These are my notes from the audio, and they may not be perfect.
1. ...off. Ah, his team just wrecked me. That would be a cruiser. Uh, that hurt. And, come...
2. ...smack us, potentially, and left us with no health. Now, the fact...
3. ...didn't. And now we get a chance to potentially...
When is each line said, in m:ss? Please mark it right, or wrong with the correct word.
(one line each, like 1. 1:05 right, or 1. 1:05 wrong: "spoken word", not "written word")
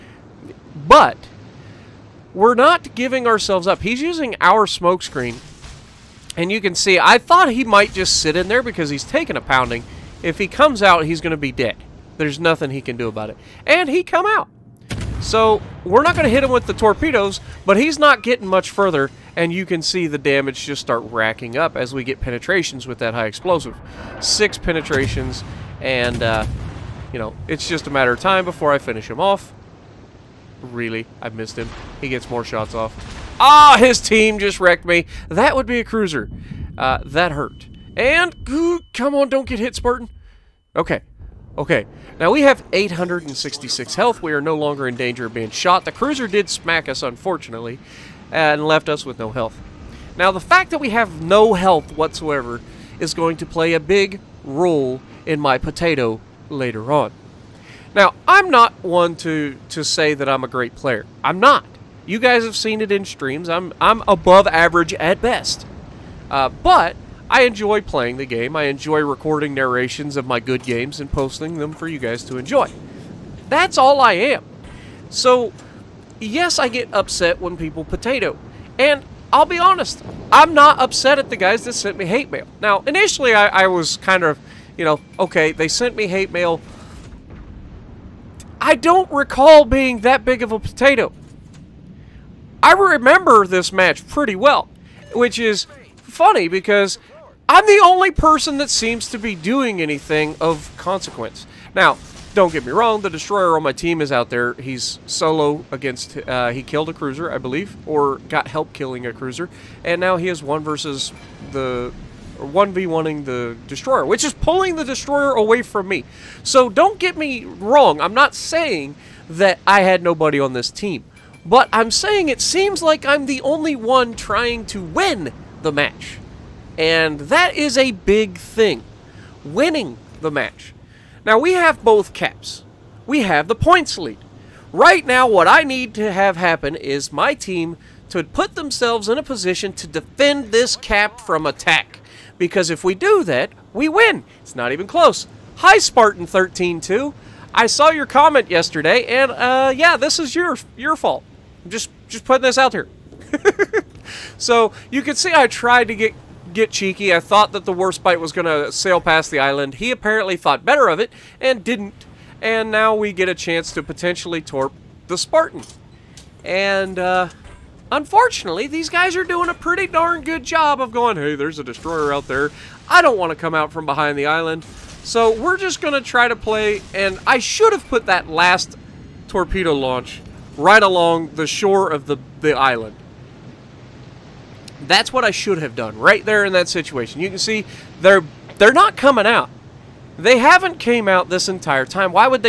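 1. 0:32 right
2. 0:46 wrong: "unfortunately", not "potentially"
3. 2:41 right.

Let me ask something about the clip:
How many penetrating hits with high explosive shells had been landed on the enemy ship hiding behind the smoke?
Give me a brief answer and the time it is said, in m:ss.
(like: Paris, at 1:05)
Six, at 0:24.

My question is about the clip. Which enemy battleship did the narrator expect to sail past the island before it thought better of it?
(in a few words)
Warspite.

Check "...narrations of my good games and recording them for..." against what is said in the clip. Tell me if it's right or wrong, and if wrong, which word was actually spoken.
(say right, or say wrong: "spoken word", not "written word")
wrong: "posting", not "recording".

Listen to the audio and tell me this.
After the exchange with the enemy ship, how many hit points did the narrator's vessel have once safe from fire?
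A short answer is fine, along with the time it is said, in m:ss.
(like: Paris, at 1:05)
866, at 0:42.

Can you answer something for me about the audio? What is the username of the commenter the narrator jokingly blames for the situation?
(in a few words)
Spartan 13-2.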